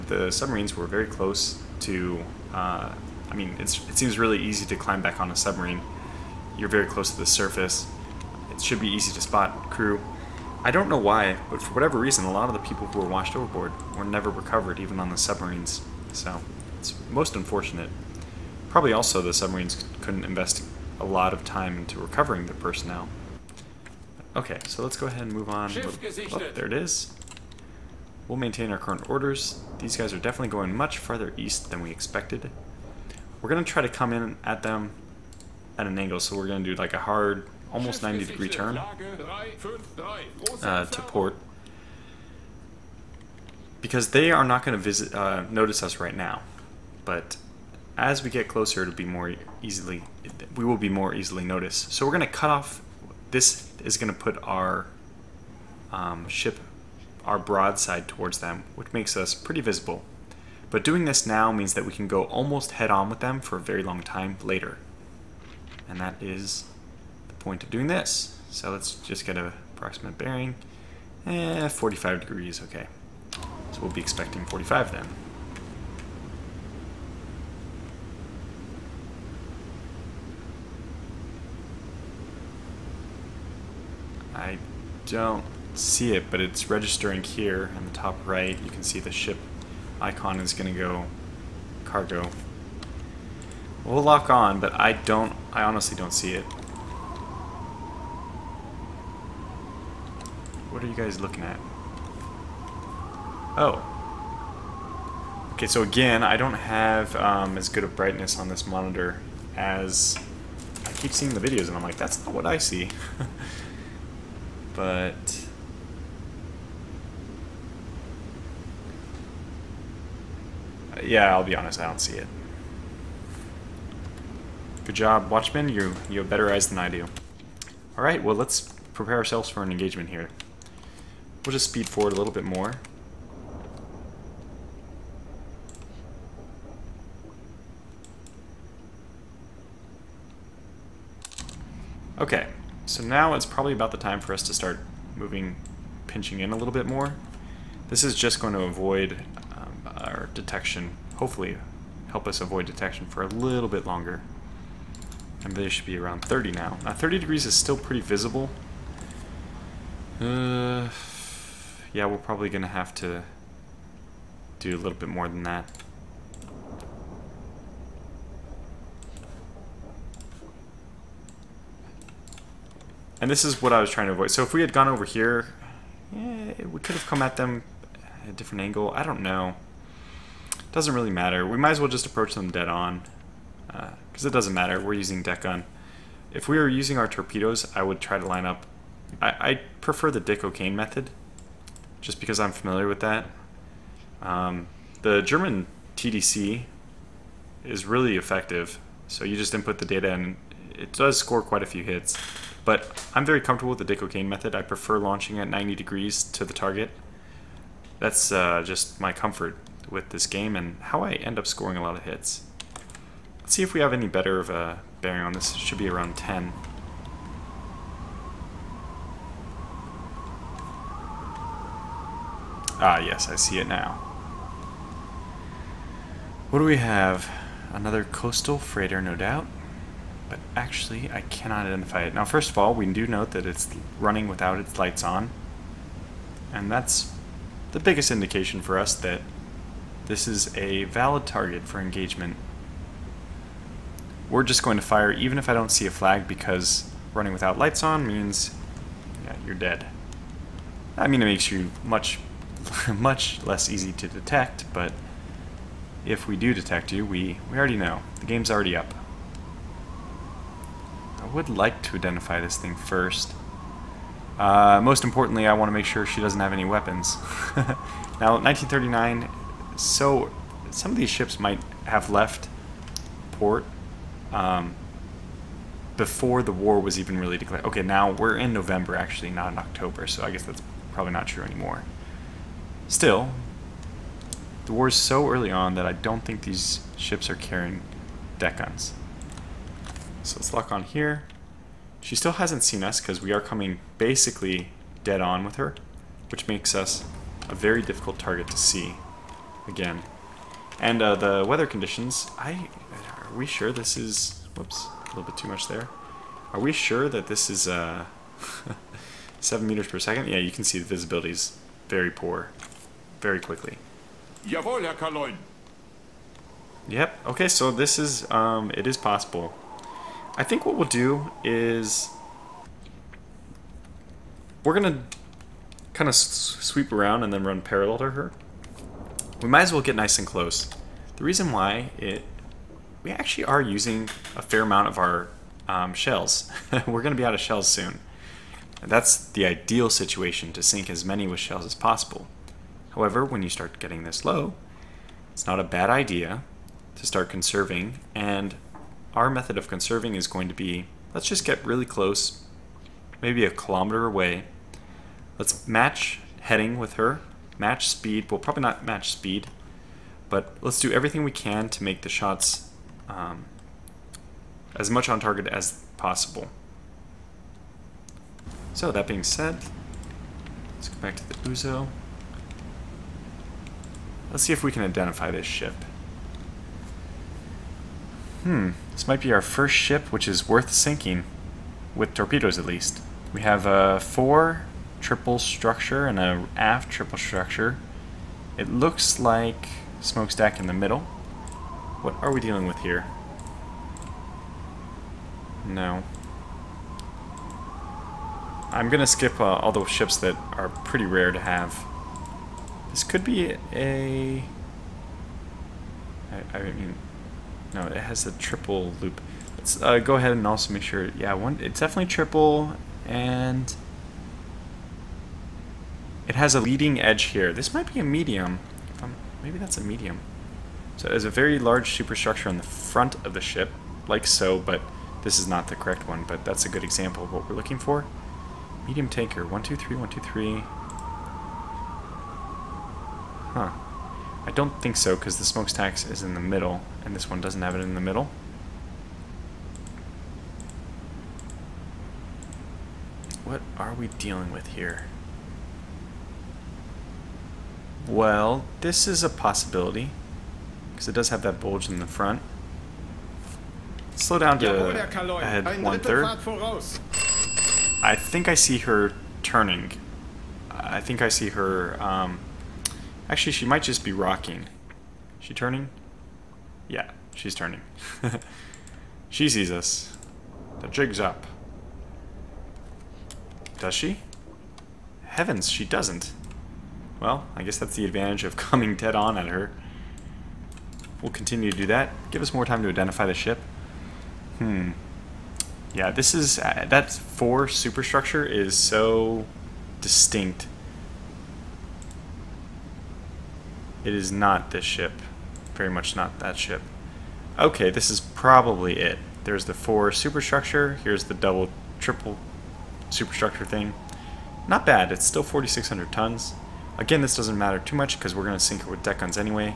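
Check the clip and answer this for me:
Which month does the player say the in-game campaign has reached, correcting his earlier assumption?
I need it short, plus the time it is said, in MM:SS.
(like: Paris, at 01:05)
November, at 04:38.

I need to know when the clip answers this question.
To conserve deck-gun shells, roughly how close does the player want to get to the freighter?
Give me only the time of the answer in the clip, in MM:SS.
05:53.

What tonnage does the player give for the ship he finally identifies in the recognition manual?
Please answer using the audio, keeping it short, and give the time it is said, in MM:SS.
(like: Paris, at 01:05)
4,600 tons, at 08:25.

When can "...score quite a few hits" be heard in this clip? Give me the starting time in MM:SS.
03:21.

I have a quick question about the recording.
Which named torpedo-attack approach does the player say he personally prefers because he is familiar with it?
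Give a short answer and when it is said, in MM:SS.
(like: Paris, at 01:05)
Dick O'Kane method, at 03:10.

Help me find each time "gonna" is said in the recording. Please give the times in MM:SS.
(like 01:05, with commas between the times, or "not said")
05:24, 05:37, 06:38.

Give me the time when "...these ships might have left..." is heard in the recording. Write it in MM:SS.
04:30.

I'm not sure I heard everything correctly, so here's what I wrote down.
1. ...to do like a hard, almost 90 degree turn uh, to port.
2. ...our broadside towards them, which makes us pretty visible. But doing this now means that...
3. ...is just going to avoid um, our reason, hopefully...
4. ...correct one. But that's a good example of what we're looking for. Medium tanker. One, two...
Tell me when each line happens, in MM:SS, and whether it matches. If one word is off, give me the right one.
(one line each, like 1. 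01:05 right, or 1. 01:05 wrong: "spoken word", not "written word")
1. 00:36 right
2. 00:57 right
3. 02:28 wrong: "detection", not "reason"
4. 07:05 right.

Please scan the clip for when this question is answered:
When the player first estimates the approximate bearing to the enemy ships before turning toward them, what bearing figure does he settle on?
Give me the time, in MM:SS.
01:11.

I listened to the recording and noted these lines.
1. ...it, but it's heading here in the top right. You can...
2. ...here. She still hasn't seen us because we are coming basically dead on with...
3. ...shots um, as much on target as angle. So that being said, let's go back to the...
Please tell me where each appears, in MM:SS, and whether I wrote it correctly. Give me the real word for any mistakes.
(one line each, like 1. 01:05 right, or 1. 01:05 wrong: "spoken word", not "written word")
1. 01:26 wrong: "registering", not "heading"
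2. 04:50 right
3. 06:02 wrong: "possible", not "angle".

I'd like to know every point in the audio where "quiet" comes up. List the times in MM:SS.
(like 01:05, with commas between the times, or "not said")
not said.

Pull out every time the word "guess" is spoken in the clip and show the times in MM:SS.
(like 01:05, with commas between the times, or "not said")
04:40, 07:57.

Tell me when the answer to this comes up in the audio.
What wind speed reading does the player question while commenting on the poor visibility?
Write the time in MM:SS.
05:09.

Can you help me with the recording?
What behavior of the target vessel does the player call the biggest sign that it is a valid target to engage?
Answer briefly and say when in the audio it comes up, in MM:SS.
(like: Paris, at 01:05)
Running without lights, at 03:53.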